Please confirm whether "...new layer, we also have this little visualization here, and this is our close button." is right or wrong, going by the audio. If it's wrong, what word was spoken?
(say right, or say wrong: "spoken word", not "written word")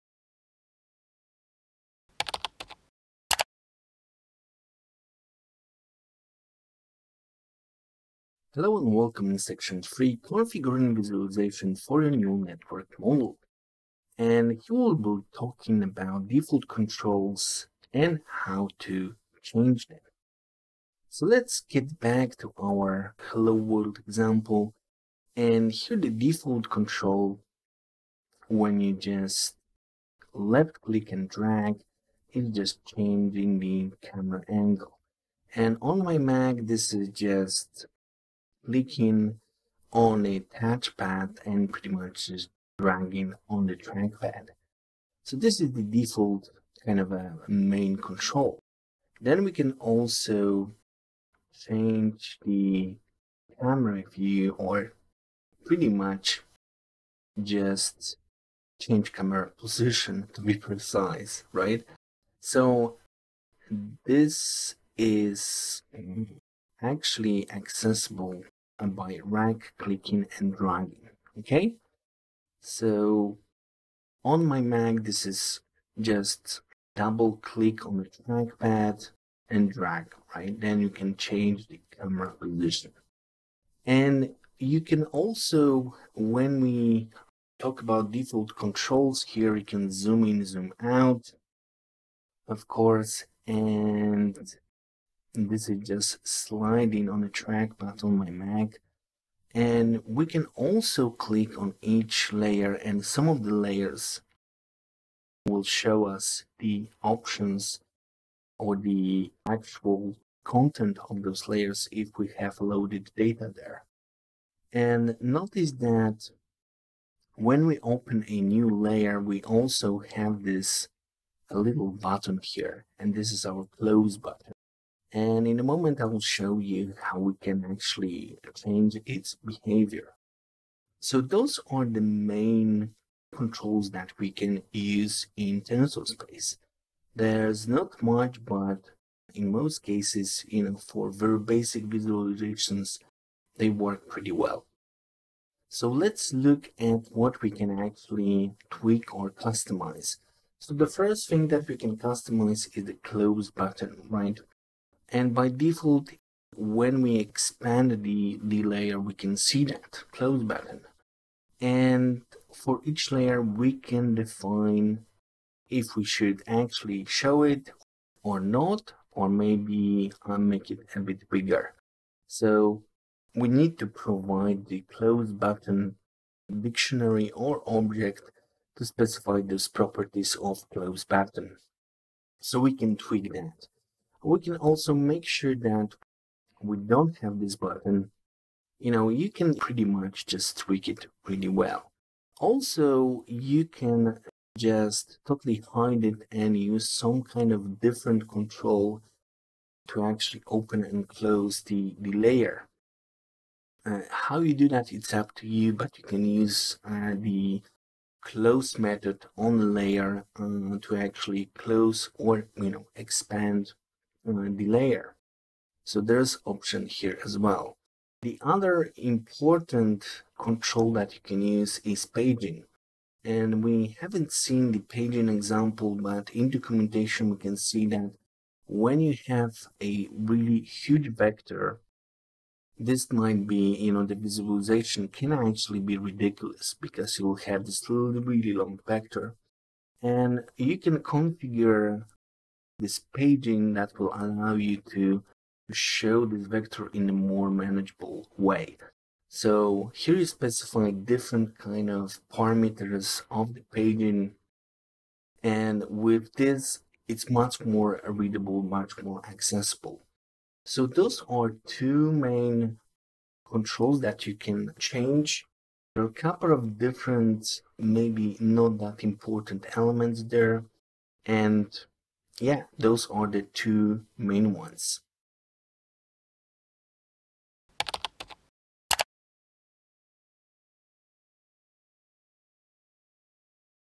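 wrong: "button", not "visualization".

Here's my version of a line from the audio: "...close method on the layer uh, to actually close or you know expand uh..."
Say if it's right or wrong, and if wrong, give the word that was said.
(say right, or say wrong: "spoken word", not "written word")
right.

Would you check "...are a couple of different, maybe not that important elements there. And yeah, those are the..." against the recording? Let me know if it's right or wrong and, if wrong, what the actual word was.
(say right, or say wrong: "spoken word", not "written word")
right.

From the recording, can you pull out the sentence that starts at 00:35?
And on my Mac, this is just clicking on a touchpad and pretty much just dragging on the trackpad.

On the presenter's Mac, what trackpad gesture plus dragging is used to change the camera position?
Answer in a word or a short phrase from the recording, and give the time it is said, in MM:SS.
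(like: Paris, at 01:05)
Double click, at 01:16.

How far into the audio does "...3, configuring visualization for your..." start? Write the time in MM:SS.
00:09.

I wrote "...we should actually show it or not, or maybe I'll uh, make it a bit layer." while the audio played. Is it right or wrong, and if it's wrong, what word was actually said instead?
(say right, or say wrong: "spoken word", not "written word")
wrong: "bigger", not "layer".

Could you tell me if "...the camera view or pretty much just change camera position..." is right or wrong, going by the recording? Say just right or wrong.
right.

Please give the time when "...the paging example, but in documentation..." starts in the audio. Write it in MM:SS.
03:44.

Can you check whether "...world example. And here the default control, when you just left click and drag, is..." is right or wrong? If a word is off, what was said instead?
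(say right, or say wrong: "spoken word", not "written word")
right.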